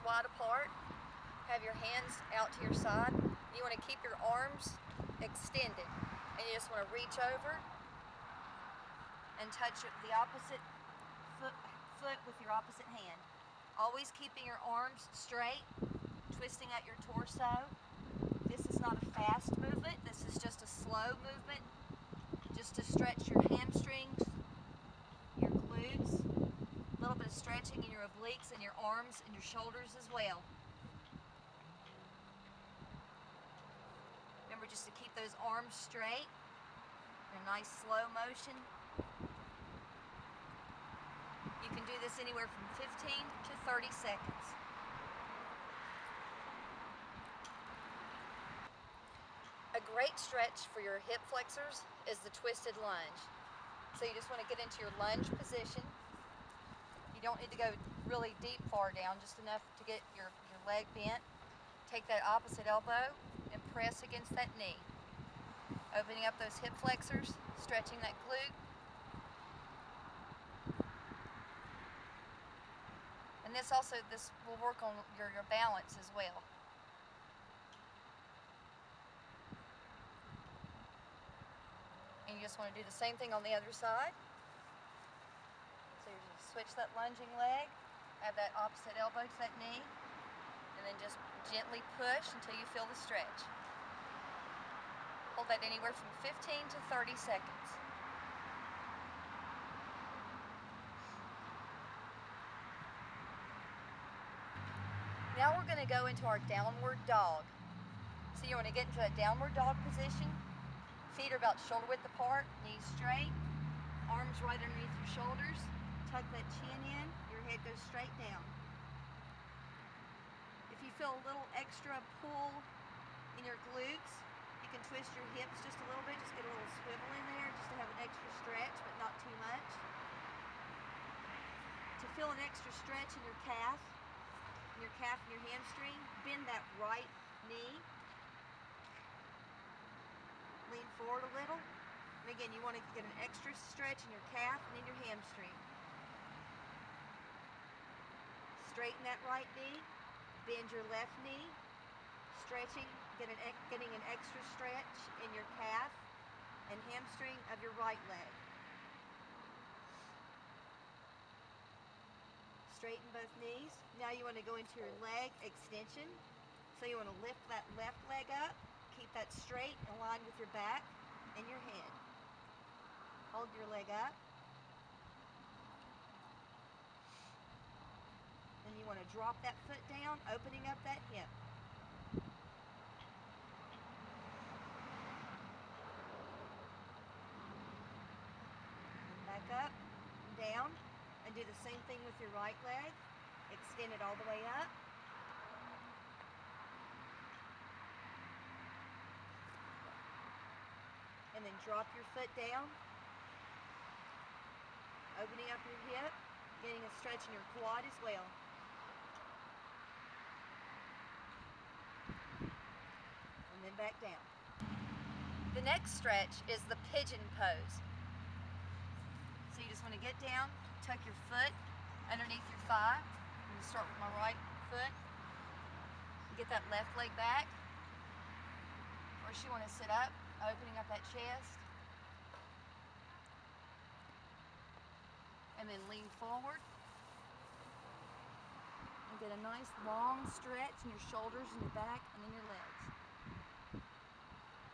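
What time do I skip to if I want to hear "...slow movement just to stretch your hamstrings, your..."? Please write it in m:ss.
0:20.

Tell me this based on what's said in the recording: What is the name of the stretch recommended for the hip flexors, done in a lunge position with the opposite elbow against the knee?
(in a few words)
twisted lunge.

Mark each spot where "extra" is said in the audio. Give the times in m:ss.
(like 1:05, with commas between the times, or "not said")
2:01, 2:08, 2:12, 2:23, 2:34.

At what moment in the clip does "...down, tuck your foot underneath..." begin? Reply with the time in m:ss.
3:40.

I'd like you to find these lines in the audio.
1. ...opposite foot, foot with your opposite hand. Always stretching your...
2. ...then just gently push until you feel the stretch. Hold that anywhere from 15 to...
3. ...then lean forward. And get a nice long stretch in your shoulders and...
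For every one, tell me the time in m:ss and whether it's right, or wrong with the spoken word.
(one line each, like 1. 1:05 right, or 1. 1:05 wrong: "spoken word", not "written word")
1. 0:10 wrong: "keeping", not "stretching"
2. 1:30 right
3. 3:55 right.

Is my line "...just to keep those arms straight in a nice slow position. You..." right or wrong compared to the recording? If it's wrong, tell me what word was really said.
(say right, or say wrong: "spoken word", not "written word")
wrong: "motion", not "position".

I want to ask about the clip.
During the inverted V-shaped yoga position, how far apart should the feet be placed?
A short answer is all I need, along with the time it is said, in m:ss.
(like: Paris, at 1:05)
shoulder width apart, at 1:51.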